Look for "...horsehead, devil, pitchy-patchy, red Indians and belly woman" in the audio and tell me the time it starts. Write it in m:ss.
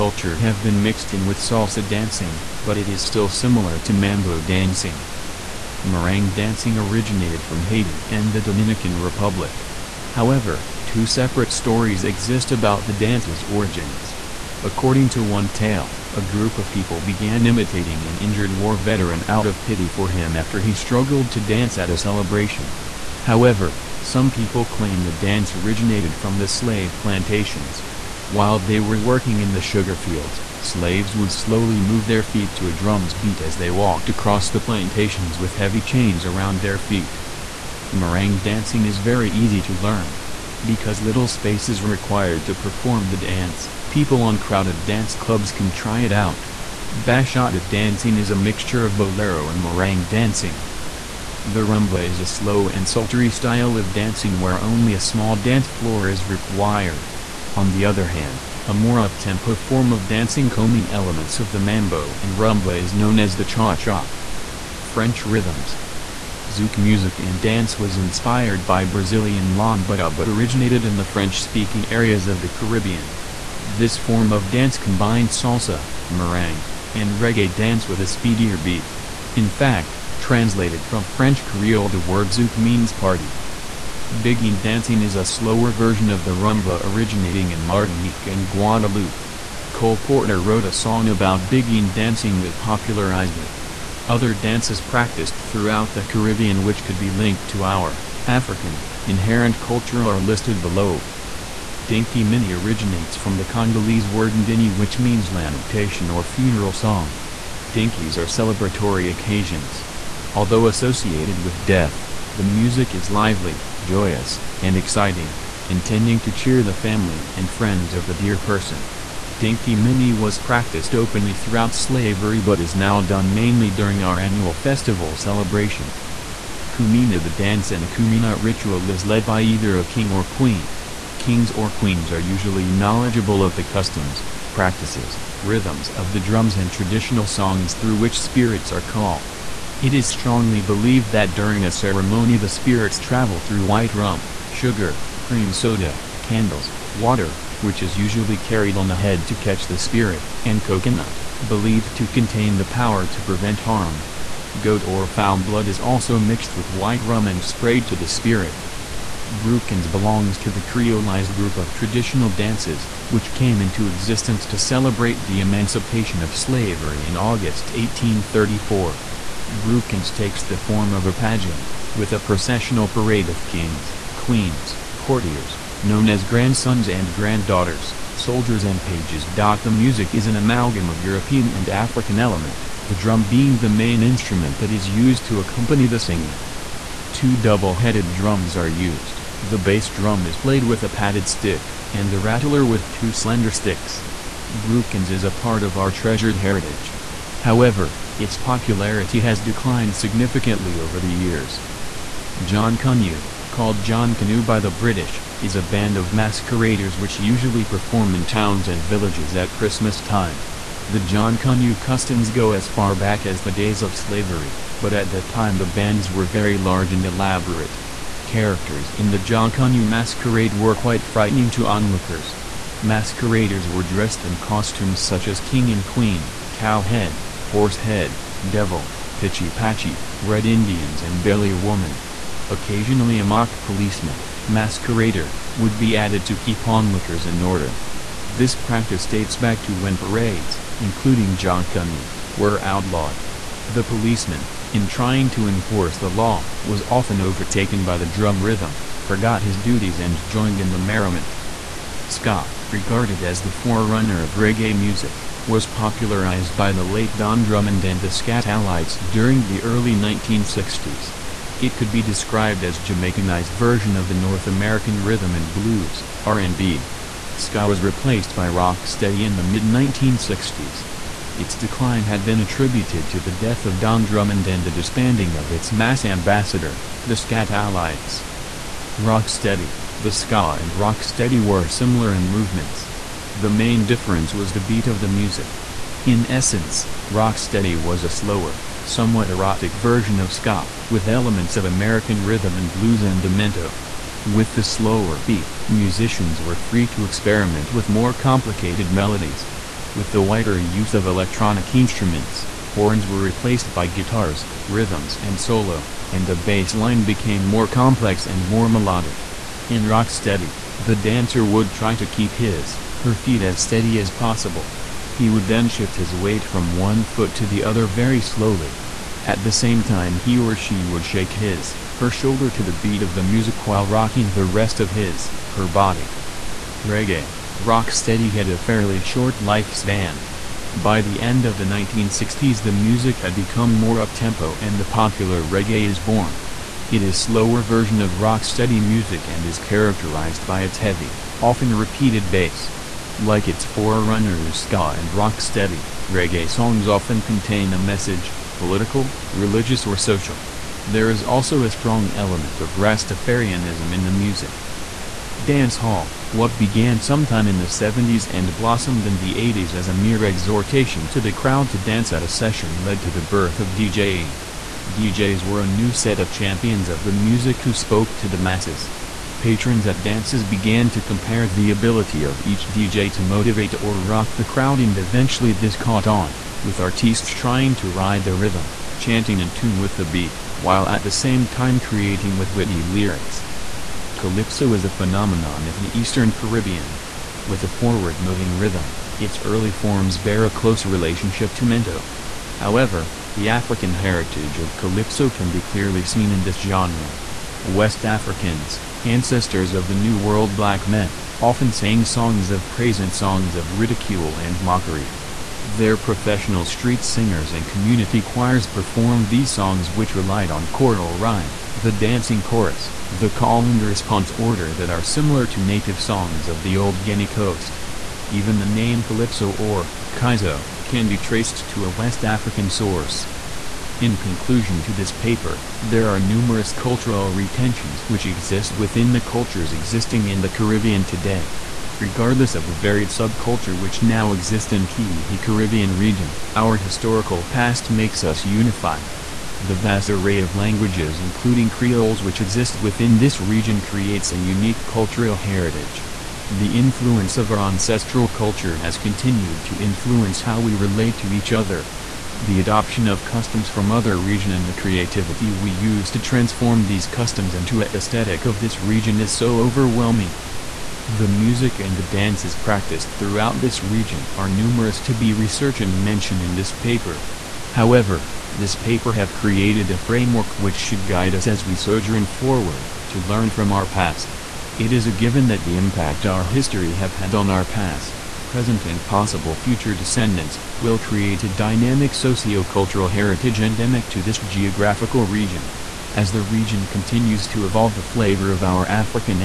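3:47.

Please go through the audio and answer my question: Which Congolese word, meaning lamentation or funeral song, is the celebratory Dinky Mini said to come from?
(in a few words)
ndini.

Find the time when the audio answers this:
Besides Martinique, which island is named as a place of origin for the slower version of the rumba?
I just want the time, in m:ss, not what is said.
1:28.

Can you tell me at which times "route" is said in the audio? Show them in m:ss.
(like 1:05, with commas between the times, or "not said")
not said.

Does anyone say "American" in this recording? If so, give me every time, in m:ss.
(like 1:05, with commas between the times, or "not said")
4:24, 4:51.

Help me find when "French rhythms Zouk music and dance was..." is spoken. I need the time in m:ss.
1:04.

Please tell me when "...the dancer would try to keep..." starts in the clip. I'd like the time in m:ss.
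5:10.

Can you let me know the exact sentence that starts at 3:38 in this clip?
Characters in the Jonkonnu masquerade were quite frightening to onlookers.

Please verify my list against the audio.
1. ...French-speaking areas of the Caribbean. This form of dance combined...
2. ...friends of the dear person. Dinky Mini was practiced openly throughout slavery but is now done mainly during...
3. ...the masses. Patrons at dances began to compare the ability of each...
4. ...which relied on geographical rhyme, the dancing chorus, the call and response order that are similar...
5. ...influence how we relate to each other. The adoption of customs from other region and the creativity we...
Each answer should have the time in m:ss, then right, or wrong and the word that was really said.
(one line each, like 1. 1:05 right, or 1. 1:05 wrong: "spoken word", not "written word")
1. 1:11 right
2. 1:57 right
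3. 6:08 right
4. 6:49 wrong: "choral", not "geographical"
5. 7:29 right.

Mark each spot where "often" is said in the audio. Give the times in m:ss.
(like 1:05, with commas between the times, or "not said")
4:06, 5:41, 5:46, 6:41.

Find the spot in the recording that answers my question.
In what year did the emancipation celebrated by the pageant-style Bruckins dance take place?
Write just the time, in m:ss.
2:47.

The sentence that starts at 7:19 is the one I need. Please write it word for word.
The vast array of languages including Creoles which exist within this region creates a unique cultural heritage.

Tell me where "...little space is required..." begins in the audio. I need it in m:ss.
0:41.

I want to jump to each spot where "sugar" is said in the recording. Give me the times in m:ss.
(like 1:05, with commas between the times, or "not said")
0:29, 2:24.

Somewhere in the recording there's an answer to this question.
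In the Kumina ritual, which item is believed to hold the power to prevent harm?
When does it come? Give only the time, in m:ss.
2:30.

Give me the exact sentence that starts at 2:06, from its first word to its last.
Kumina The dance in a Kumina ritual is led by either a king or queen.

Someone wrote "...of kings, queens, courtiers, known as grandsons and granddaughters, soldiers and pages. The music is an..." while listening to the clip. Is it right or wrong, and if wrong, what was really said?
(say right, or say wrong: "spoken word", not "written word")
right.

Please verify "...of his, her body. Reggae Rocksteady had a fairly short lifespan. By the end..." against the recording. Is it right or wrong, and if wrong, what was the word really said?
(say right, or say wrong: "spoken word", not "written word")
right.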